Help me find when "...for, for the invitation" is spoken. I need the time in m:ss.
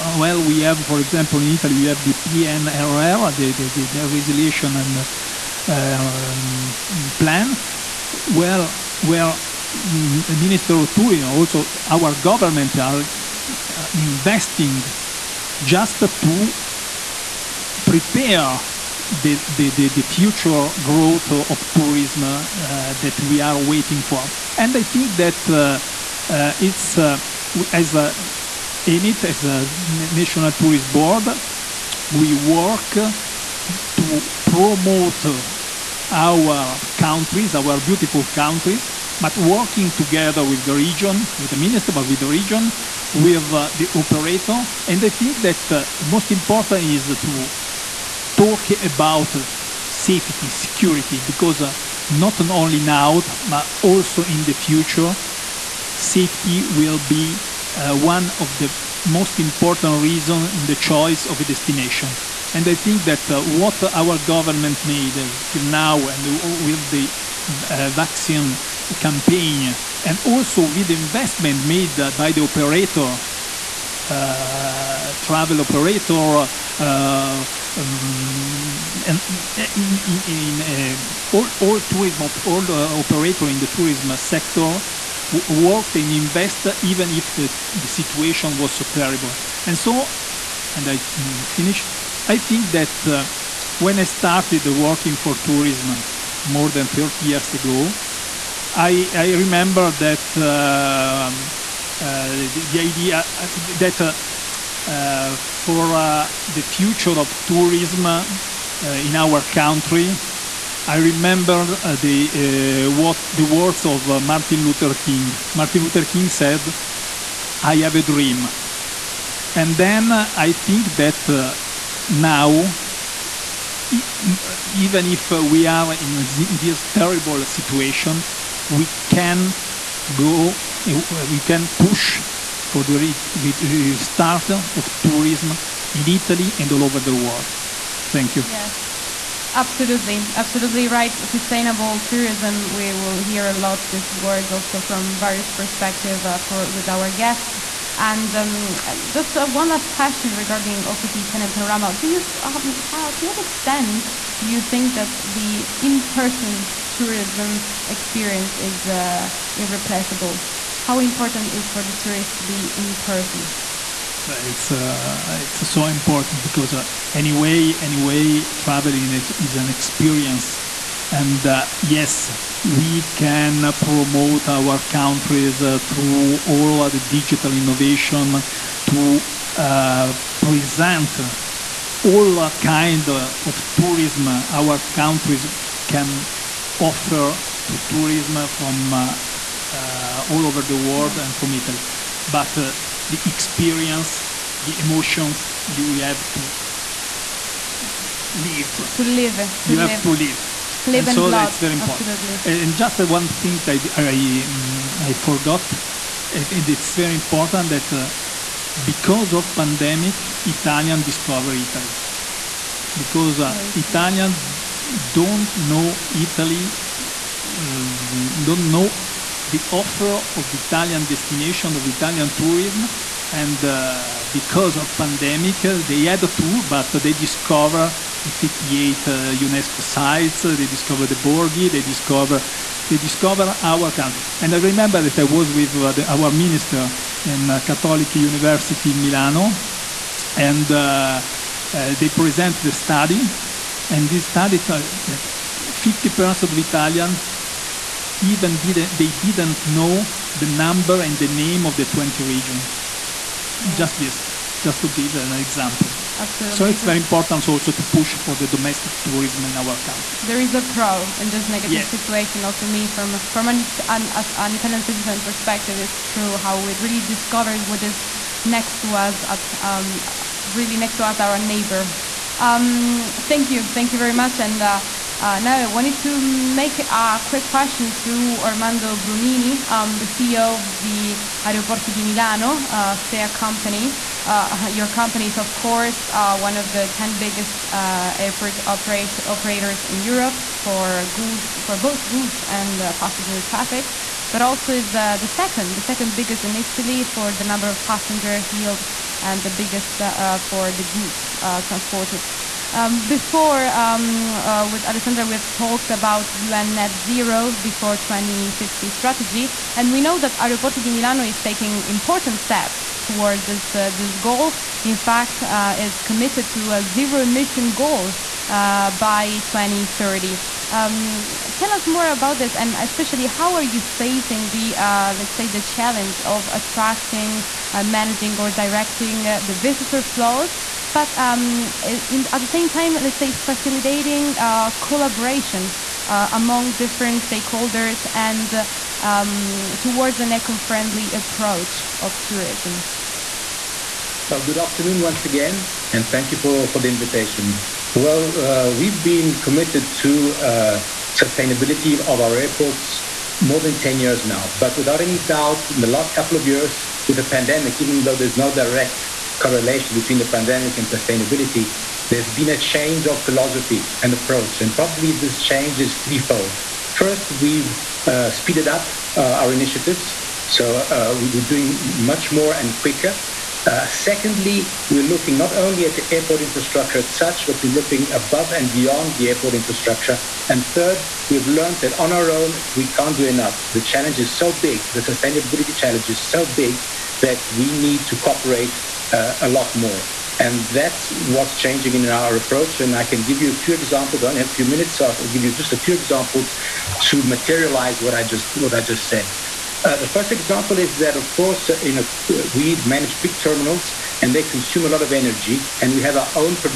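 5:46.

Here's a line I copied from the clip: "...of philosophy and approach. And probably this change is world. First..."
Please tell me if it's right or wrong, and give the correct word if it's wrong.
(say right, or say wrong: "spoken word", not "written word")
wrong: "threefold", not "world".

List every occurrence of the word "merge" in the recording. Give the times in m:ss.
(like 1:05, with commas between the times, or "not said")
not said.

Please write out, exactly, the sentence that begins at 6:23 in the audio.
The challenge is so big, the sustainability challenge is so big that we need to cooperate uh, a lot more.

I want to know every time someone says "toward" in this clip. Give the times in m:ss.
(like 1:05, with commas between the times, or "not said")
5:13, 5:39.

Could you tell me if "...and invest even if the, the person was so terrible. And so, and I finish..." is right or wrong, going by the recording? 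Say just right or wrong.
wrong.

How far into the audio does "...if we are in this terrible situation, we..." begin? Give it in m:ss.
2:05.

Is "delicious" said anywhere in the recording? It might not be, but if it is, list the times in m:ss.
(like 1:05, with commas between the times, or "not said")
not said.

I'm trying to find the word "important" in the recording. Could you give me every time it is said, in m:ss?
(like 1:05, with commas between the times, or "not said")
0:46, 0:59, 2:40, 2:45, 3:21, 3:27, 4:16, 5:11.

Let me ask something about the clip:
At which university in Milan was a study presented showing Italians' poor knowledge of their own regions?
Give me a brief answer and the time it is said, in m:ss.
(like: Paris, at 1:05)
Catholic University Milano, at 3:57.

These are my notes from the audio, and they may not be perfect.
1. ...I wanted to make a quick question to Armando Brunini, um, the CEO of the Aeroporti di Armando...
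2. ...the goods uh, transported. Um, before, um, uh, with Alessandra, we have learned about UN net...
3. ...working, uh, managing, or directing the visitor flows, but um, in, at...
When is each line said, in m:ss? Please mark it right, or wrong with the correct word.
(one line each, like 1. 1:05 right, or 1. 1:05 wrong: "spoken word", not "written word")
1. 4:35 wrong: "Milano", not "Armando"
2. 5:00 wrong: "talked", not "learned"
3. 5:26 wrong: "attracting", not "working".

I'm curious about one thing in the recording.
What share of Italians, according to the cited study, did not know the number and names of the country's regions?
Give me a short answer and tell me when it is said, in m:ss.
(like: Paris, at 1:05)
50%, at 4:04.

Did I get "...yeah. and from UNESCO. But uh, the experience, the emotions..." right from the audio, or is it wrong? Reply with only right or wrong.
wrong.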